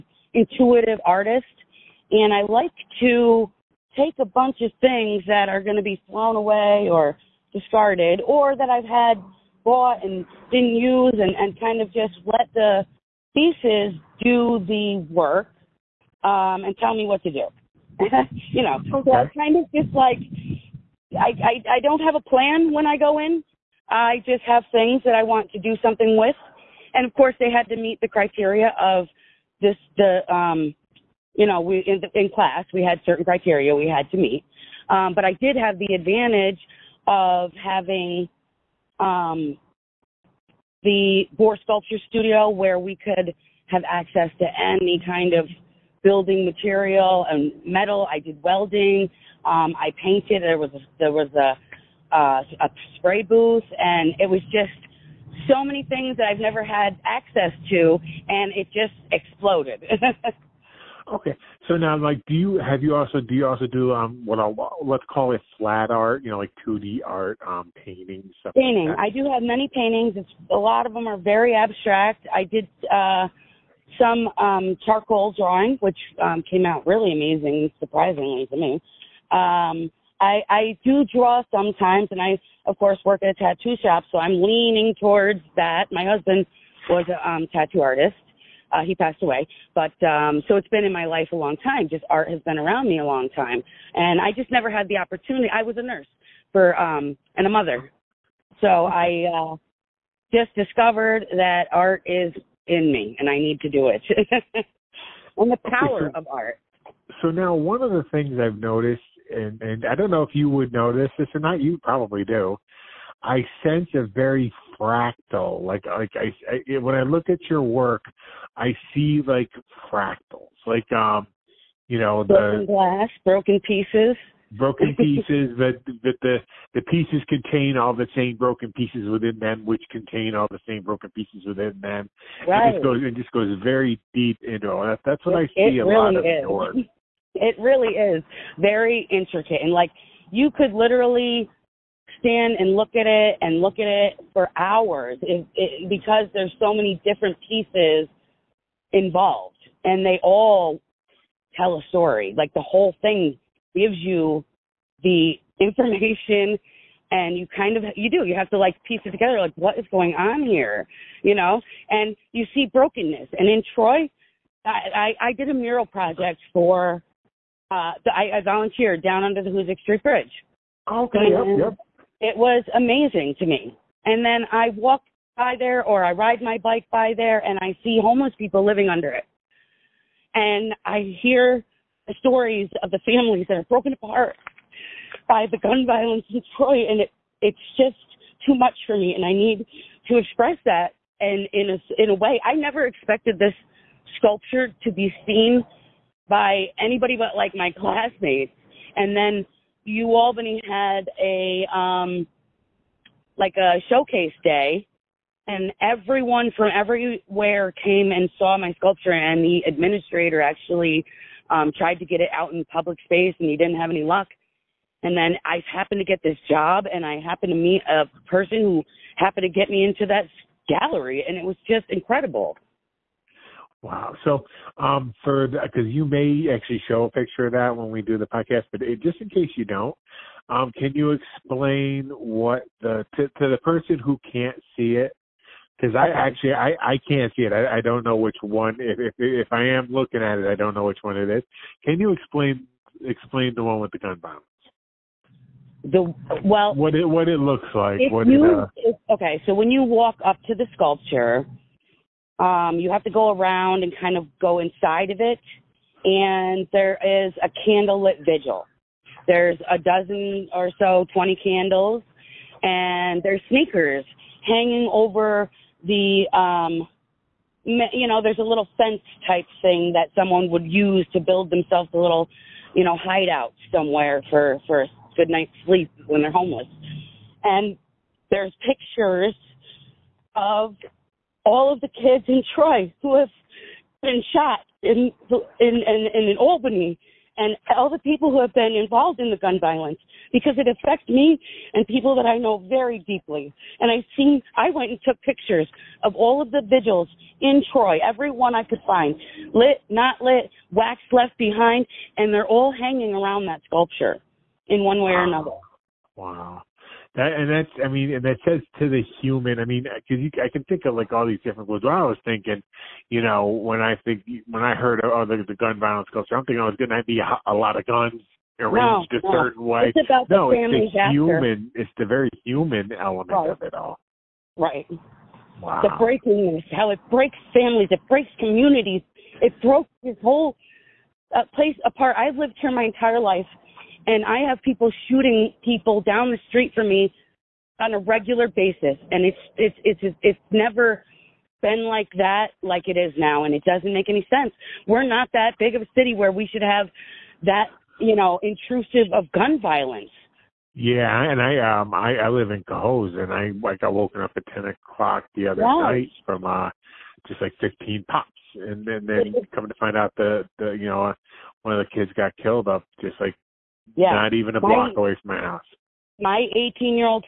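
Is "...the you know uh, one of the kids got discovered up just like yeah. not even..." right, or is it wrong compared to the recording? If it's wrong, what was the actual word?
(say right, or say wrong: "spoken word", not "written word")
wrong: "killed", not "discovered".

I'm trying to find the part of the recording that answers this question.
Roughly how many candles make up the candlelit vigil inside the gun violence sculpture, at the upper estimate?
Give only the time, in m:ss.
4:21.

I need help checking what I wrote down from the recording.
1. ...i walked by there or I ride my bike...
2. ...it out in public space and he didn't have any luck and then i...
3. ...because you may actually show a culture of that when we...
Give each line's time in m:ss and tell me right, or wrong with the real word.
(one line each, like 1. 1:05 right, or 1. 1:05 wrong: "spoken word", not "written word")
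1. 2:54 right
2. 3:32 right
3. 3:45 wrong: "picture", not "culture".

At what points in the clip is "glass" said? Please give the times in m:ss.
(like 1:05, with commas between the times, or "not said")
2:02.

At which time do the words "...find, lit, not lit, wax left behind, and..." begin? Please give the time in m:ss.
4:58.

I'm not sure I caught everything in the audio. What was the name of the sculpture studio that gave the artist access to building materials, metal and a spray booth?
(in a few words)
Boar Sculpture Studio.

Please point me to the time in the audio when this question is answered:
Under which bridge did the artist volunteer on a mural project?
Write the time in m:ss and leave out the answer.
2:49.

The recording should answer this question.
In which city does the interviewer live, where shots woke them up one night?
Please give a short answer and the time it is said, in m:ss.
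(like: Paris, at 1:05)
Cohoes, at 5:52.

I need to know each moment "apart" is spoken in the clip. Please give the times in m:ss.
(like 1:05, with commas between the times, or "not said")
3:03, 5:31.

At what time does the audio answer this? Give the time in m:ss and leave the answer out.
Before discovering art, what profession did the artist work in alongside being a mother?
1:35.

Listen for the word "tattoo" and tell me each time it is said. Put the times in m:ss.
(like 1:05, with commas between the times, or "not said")
1:23, 1:27.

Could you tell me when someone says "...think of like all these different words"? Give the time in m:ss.
5:10.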